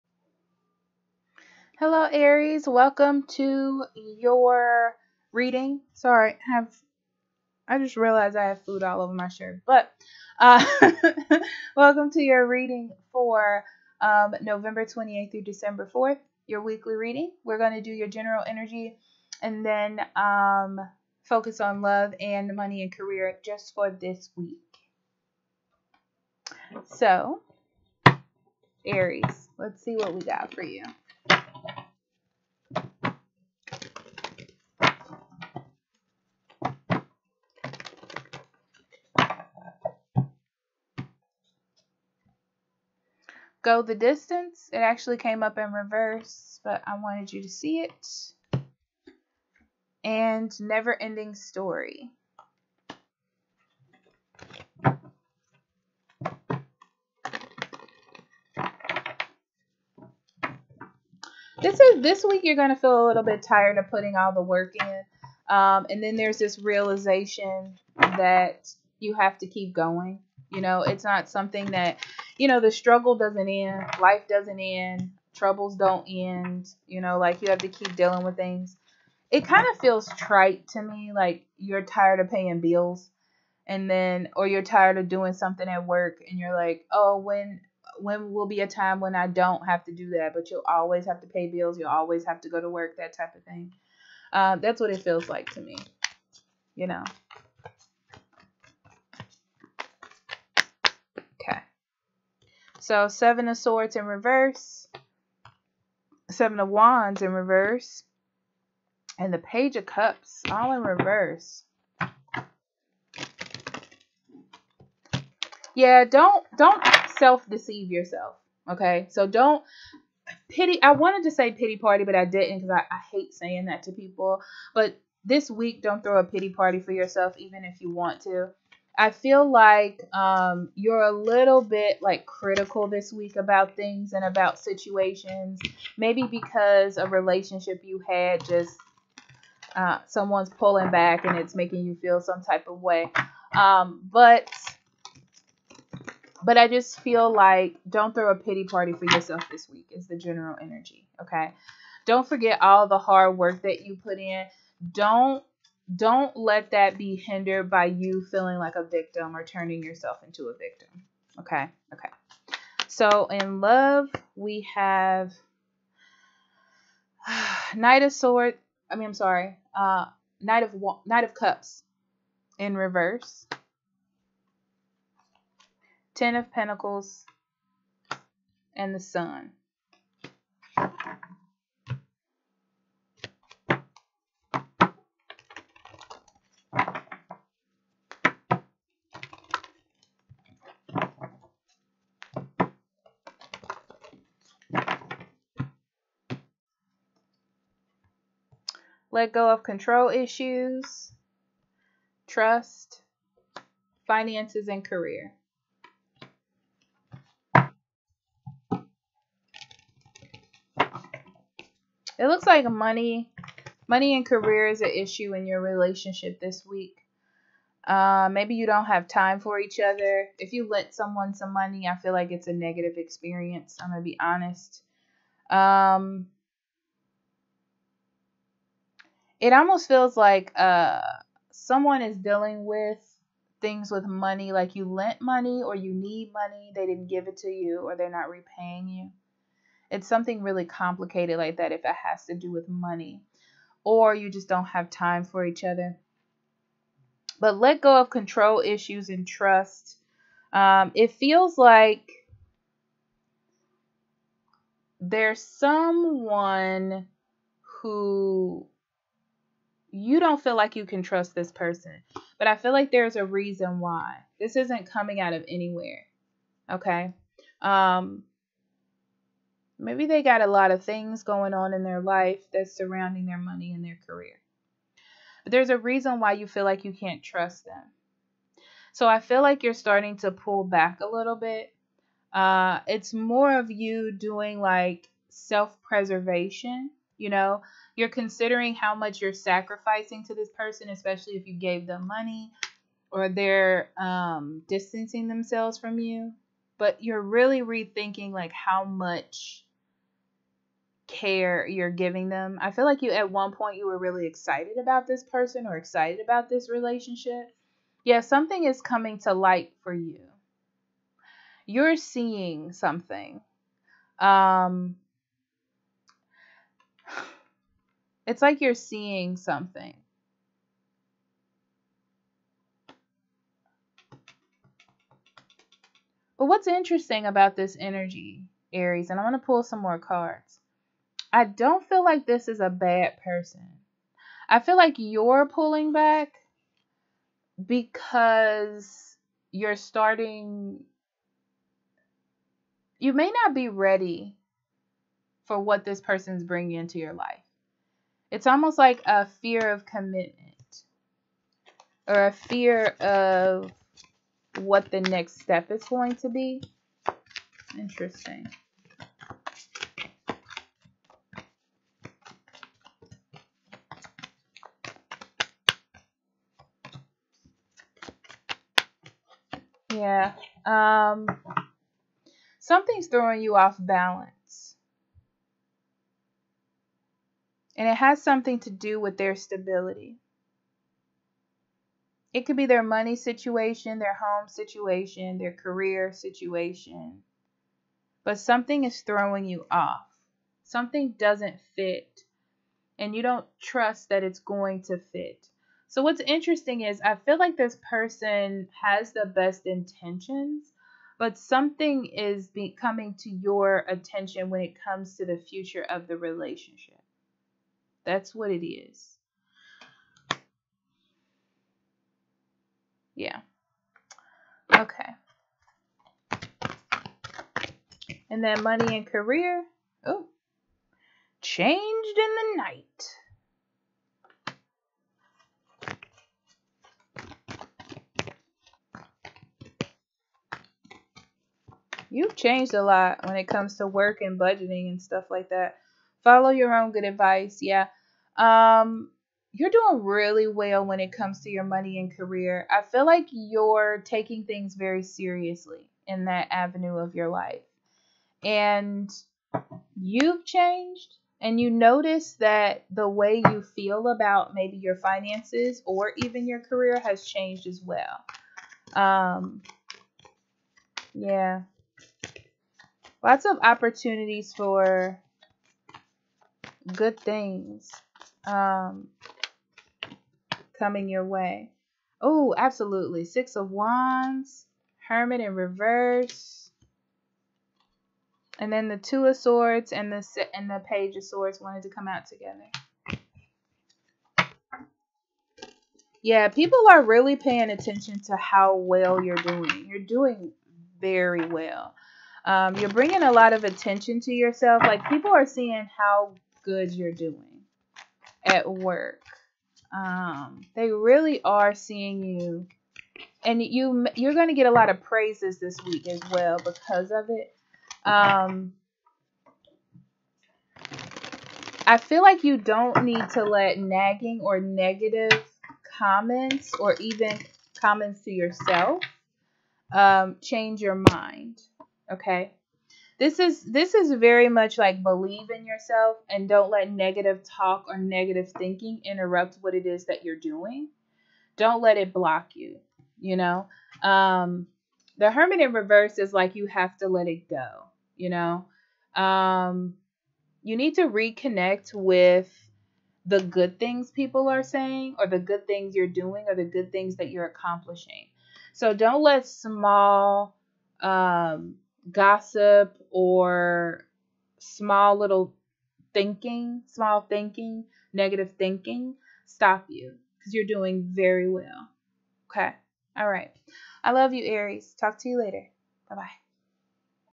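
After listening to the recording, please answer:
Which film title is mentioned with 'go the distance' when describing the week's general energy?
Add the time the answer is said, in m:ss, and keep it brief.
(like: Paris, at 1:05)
Never Ending Story, at 0:50.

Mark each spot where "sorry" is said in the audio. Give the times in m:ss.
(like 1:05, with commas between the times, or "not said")
0:05, 2:49.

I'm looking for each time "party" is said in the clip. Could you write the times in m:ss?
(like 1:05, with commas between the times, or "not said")
2:01, 2:06, 2:28.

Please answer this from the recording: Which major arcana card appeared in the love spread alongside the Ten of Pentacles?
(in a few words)
The Sun.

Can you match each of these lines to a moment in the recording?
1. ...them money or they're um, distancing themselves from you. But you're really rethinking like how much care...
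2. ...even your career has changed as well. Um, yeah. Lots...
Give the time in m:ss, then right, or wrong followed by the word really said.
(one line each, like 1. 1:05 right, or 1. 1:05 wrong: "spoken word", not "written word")
1. 4:51 right
2. 7:36 right.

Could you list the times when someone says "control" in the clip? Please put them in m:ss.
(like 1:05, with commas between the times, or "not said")
3:19, 4:08.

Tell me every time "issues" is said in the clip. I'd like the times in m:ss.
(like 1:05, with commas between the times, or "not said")
3:20, 3:34, 4:08.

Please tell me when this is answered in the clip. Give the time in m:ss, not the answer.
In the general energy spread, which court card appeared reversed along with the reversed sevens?
1:49.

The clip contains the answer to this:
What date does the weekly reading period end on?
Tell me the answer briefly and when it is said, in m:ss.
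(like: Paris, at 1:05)
December 4th, at 0:15.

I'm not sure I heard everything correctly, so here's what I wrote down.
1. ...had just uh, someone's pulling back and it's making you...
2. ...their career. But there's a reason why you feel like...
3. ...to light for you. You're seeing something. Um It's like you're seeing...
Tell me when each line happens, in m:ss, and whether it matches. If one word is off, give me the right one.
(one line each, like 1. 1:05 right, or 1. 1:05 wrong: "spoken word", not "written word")
1. 2:18 right
2. 4:33 right
3. 5:09 right.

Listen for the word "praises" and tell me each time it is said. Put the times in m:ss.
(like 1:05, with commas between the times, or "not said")
8:25.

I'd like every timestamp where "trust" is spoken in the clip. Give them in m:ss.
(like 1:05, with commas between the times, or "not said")
3:22, 4:09, 4:21, 4:37, 6:33.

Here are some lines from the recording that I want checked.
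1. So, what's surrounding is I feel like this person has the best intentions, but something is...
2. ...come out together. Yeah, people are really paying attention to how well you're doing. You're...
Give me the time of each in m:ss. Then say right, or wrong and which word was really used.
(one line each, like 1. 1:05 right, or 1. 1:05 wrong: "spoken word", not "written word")
1. 6:35 wrong: "interesting", not "surrounding"
2. 8:01 right.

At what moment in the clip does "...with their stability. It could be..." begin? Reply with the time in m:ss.
6:18.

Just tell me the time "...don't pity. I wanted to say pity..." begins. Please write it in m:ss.
1:59.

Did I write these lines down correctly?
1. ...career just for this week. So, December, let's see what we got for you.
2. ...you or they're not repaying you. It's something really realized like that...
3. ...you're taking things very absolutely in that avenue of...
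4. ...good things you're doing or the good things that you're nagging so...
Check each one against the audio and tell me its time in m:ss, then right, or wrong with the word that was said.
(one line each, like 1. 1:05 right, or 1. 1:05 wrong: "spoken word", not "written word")
1. 0:22 wrong: "Aries", not "December"
2. 3:57 wrong: "complicated", not "realized"
3. 7:23 wrong: "seriously", not "absolutely"
4. 9:05 wrong: "accomplishing", not "nagging".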